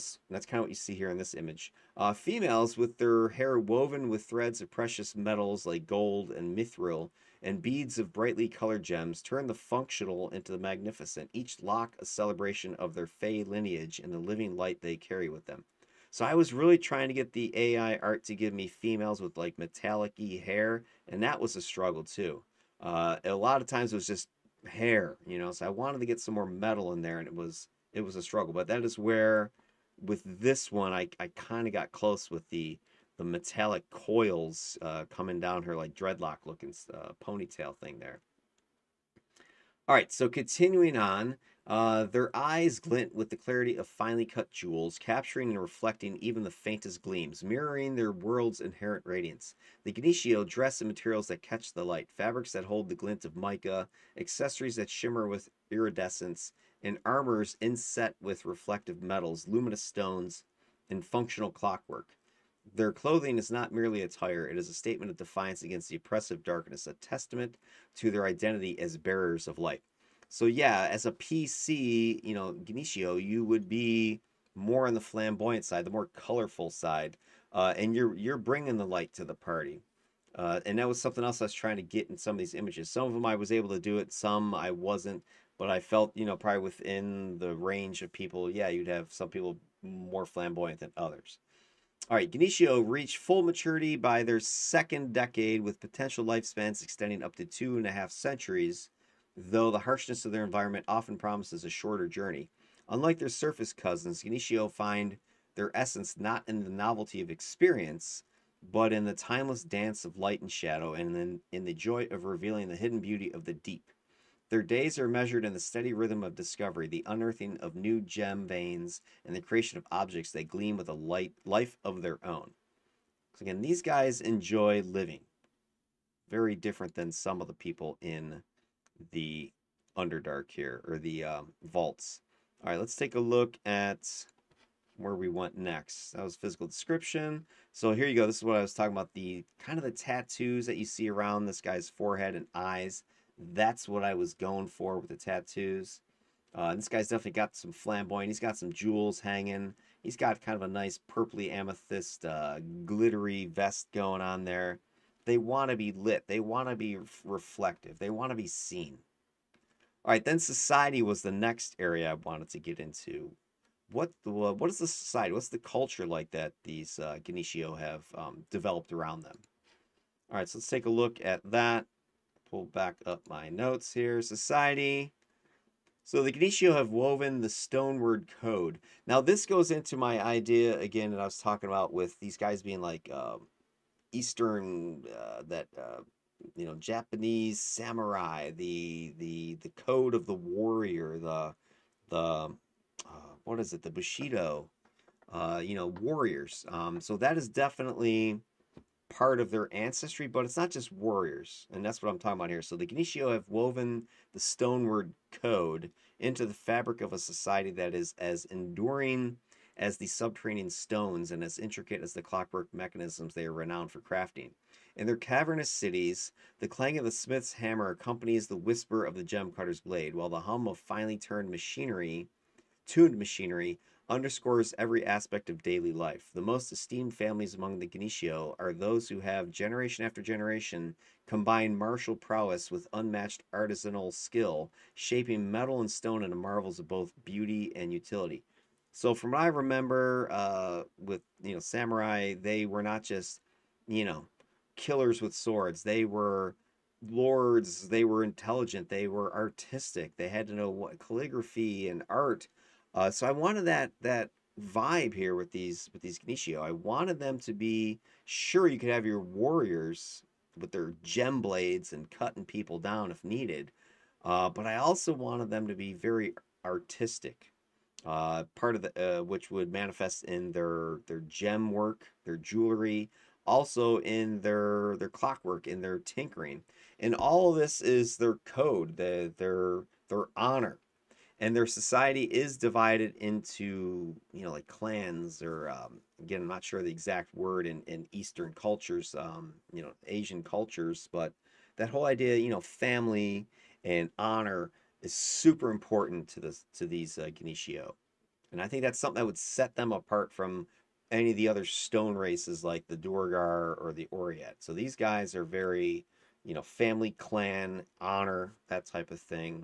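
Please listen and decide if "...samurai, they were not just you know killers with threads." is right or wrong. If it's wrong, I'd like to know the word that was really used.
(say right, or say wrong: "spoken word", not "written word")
wrong: "swords", not "threads".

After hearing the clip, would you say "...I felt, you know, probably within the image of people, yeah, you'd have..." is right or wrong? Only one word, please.
wrong.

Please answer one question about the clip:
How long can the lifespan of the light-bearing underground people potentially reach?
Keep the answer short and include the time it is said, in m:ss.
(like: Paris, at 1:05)
two and a half centuries, at 1:37.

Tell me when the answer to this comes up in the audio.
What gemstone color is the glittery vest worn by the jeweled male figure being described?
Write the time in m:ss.
2:31.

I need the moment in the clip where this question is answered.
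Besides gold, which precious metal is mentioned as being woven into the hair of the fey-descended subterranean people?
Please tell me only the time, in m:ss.
0:06.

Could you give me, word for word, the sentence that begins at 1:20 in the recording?
Uh, and that was something else I was trying to get in some of these images.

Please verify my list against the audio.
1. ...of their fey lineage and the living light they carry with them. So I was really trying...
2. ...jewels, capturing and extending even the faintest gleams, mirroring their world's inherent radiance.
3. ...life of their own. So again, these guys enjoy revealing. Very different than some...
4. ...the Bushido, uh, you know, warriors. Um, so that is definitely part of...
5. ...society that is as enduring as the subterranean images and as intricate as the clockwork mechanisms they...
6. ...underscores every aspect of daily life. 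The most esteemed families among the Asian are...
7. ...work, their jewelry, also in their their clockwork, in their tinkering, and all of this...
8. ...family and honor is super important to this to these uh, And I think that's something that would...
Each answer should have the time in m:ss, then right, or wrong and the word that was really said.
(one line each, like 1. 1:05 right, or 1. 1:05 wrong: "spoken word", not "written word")
1. 0:12 right
2. 0:44 wrong: "reflecting", not "extending"
3. 2:01 wrong: "living", not "revealing"
4. 3:13 right
5. 3:27 wrong: "stones", not "images"
6. 3:44 wrong: "Gnishiho", not "Asian"
7. 4:31 right
8. 4:52 right.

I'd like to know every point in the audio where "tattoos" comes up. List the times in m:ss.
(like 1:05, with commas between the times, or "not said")
2:19, 2:25.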